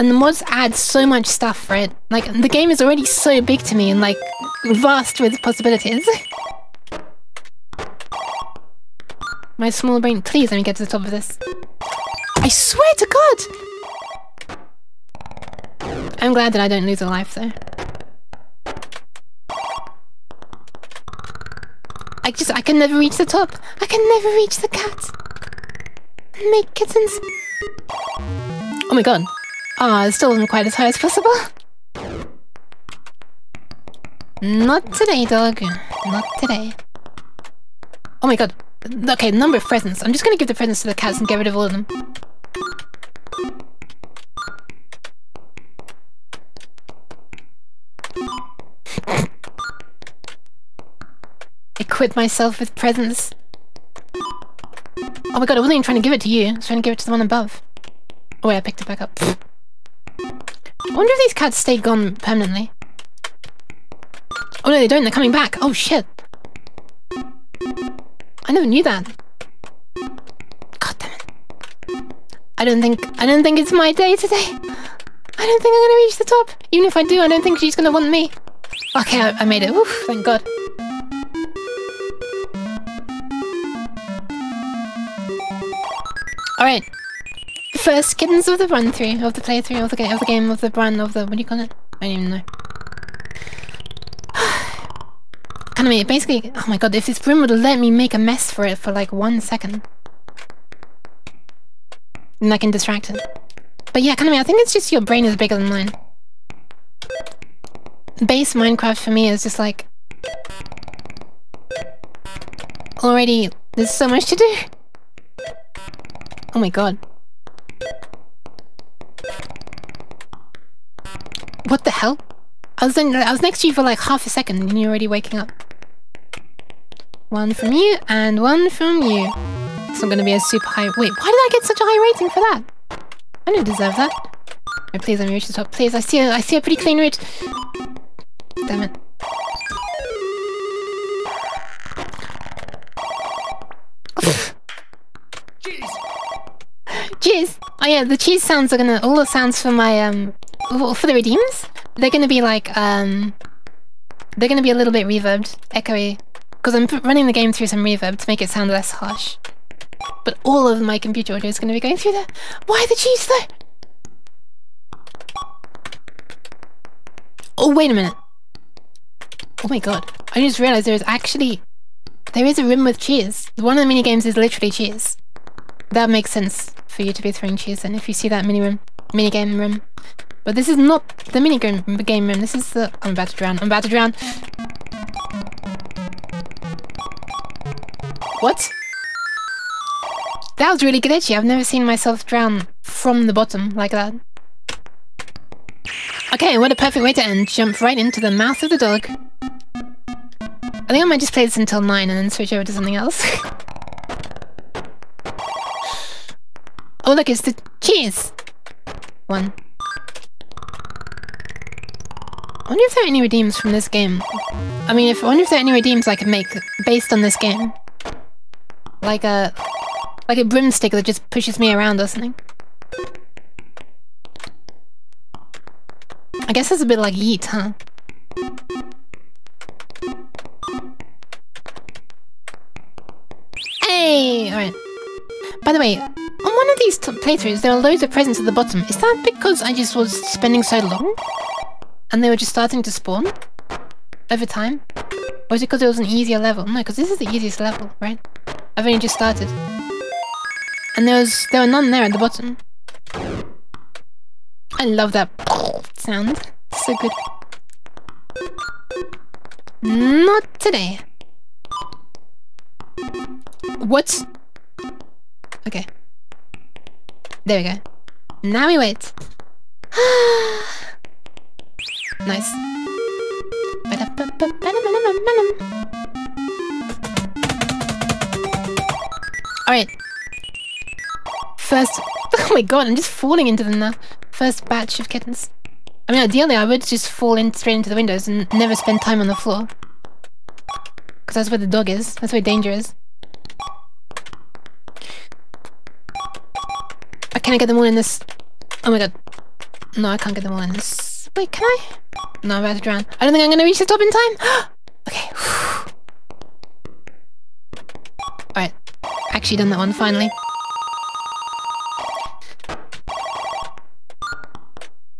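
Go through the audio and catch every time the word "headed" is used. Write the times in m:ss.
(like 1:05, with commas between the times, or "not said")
not said.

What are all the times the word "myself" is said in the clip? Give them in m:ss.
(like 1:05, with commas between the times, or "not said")
0:52, 3:11.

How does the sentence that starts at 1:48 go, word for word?
Base Minecraft for me is just like...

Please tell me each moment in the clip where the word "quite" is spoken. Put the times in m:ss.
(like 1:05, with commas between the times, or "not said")
0:30.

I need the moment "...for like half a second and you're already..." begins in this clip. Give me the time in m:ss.
2:03.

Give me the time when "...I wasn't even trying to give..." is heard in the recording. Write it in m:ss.
0:55.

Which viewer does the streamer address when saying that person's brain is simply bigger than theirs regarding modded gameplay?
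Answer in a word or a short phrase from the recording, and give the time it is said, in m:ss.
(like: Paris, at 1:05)
Kaname, at 1:44.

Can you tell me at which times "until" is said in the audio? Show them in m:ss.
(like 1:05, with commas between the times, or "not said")
3:21.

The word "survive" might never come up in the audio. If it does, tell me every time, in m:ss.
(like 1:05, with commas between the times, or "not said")
not said.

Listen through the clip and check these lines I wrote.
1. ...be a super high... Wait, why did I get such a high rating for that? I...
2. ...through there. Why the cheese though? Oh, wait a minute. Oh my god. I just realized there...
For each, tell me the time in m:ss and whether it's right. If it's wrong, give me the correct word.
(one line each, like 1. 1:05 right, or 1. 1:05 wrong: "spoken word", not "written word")
1. 2:10 right
2. 2:41 right.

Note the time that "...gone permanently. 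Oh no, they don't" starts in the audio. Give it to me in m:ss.
1:01.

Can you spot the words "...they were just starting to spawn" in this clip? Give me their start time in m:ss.
4:02.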